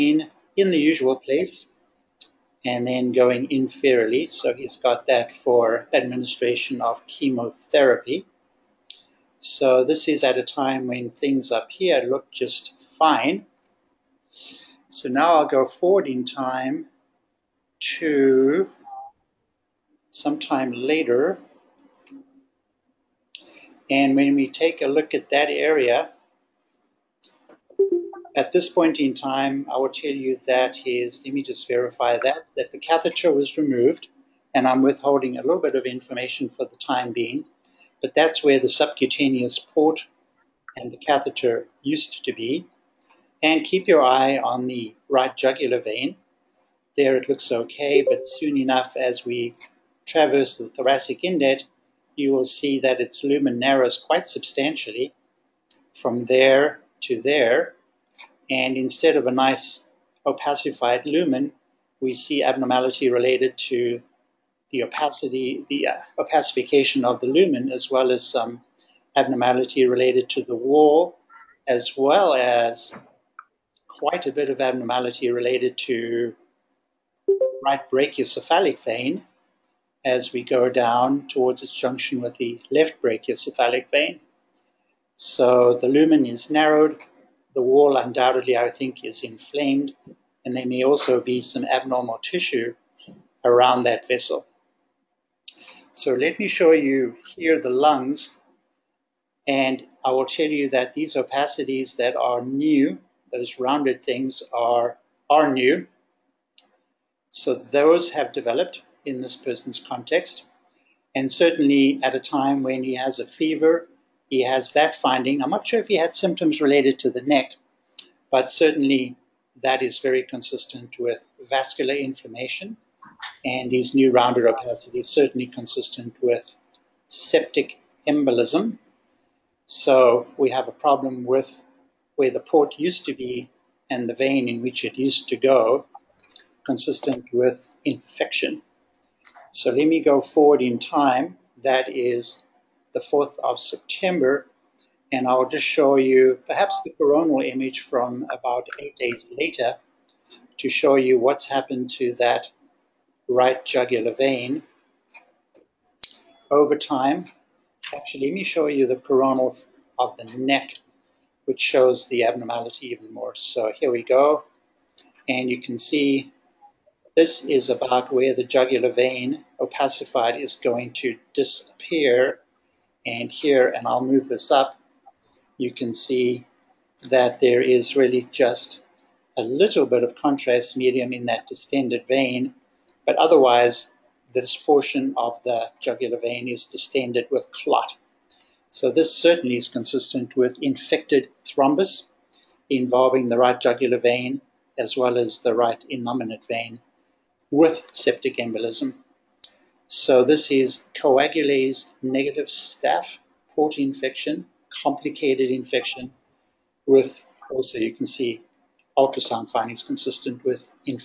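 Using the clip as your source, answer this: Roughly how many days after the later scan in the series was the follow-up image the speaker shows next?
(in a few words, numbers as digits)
8.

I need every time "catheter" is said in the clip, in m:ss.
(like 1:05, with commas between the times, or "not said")
0:32, 0:40.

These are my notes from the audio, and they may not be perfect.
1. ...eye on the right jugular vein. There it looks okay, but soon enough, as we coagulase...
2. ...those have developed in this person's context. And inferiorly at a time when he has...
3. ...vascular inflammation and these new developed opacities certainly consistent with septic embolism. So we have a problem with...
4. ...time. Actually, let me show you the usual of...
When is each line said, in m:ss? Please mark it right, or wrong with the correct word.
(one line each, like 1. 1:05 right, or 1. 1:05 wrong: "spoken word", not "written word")
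1. 0:44 wrong: "traverse", not "coagulase"
2. 1:47 wrong: "certainly", not "inferiorly"
3. 2:01 wrong: "rounded", not "developed"
4. 2:36 wrong: "coronal", not "usual".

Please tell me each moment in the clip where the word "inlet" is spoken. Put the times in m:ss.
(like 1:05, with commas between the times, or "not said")
0:51.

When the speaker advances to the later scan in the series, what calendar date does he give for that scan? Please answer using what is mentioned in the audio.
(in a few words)
4th of September.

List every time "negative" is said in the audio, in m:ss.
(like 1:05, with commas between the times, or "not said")
3:22.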